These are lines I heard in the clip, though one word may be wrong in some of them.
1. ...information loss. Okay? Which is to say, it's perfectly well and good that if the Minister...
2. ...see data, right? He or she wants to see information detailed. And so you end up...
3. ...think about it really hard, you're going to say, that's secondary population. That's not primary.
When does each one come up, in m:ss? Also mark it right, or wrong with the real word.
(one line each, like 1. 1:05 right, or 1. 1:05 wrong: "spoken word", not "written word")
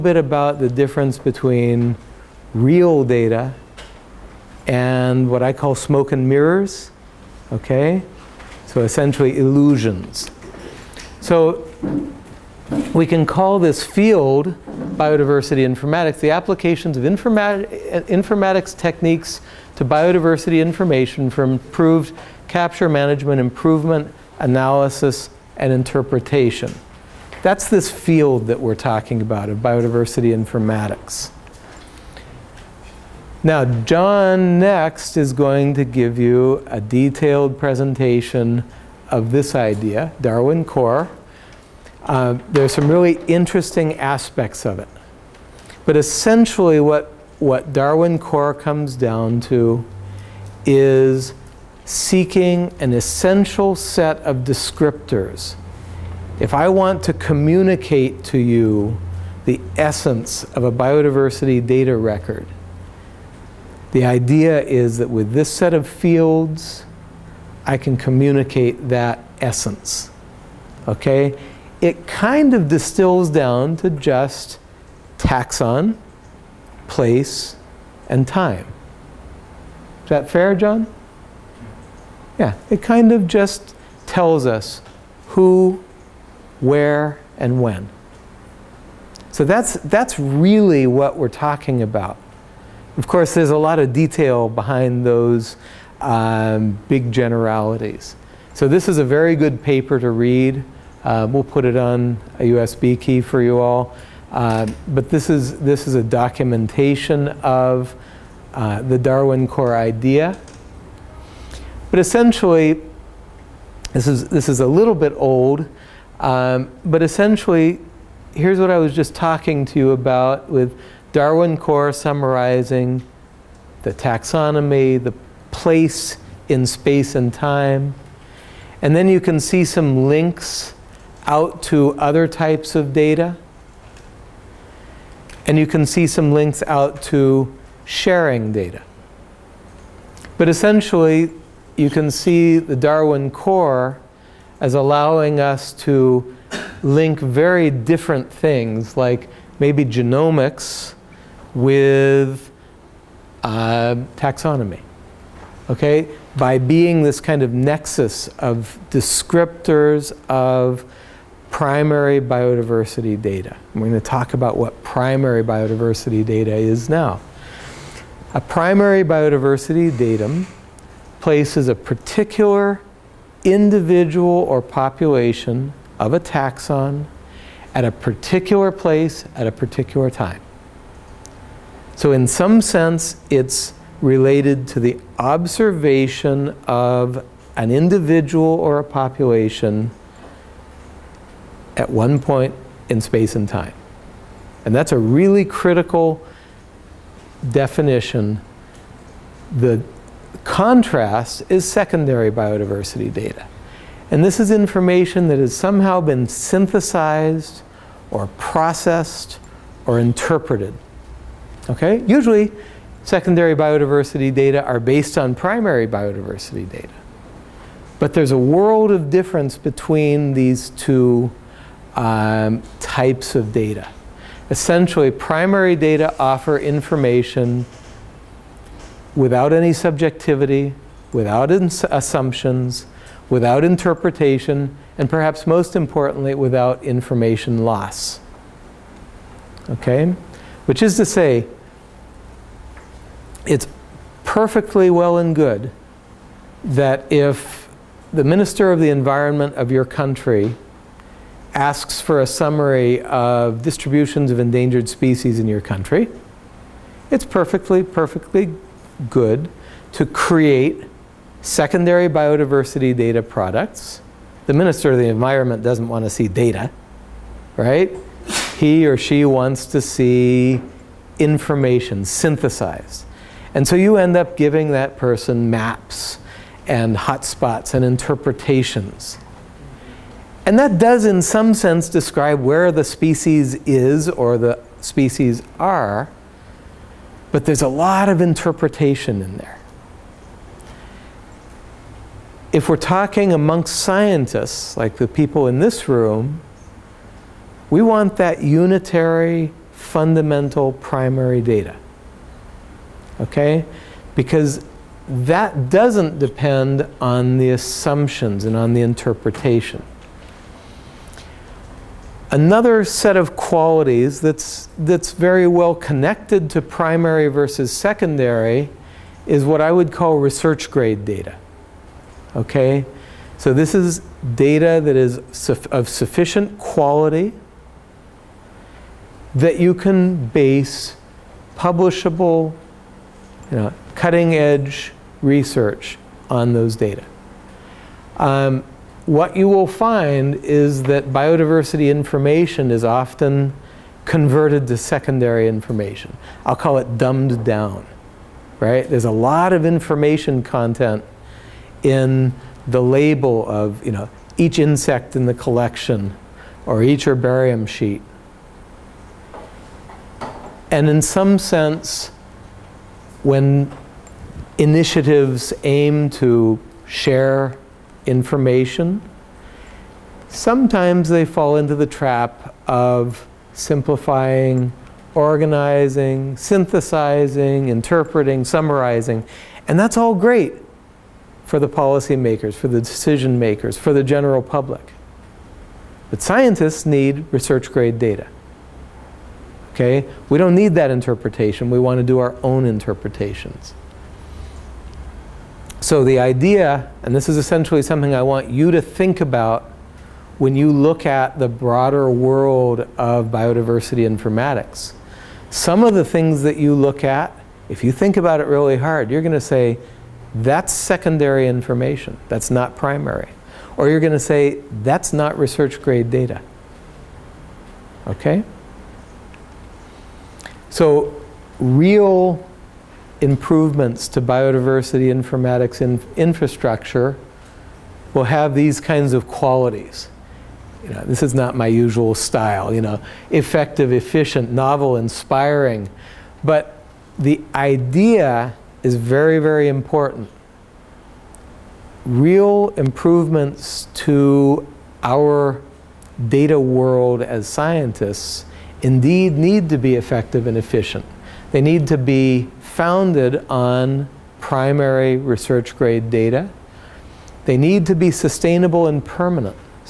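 1. 3:56 right
2. 4:26 wrong: "synthesized", not "detailed"
3. 6:47 wrong: "information", not "population".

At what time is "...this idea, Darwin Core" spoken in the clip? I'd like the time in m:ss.
0:39.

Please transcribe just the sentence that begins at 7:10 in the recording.
You know, this is not my usual style, you know, effective, efficient, novel, inspiring.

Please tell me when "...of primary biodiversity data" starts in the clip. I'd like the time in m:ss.
2:40.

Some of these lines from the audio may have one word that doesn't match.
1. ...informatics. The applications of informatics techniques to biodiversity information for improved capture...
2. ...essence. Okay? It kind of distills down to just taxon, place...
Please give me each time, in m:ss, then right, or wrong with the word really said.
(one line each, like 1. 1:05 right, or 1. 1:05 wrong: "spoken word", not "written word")
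1. 0:15 right
2. 1:09 right.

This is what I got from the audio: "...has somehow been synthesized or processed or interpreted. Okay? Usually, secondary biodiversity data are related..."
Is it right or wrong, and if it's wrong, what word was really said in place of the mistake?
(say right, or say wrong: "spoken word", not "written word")
wrong: "based", not "related".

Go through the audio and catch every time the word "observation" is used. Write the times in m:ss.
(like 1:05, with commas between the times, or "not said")
3:05.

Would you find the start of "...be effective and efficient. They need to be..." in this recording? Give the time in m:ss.
7:29.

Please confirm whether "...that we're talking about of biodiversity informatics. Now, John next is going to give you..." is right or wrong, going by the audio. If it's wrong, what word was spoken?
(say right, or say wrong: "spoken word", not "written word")
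right.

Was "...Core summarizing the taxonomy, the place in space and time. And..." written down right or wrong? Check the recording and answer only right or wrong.
right.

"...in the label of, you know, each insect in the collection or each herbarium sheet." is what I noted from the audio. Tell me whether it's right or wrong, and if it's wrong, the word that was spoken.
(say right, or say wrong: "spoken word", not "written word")
right.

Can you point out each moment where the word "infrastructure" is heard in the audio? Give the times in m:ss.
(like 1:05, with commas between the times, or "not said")
7:06.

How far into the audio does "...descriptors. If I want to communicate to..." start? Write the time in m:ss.
0:54.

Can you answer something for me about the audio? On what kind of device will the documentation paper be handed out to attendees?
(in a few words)
USB key.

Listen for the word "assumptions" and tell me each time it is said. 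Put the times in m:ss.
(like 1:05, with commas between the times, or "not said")
3:51, 5:07.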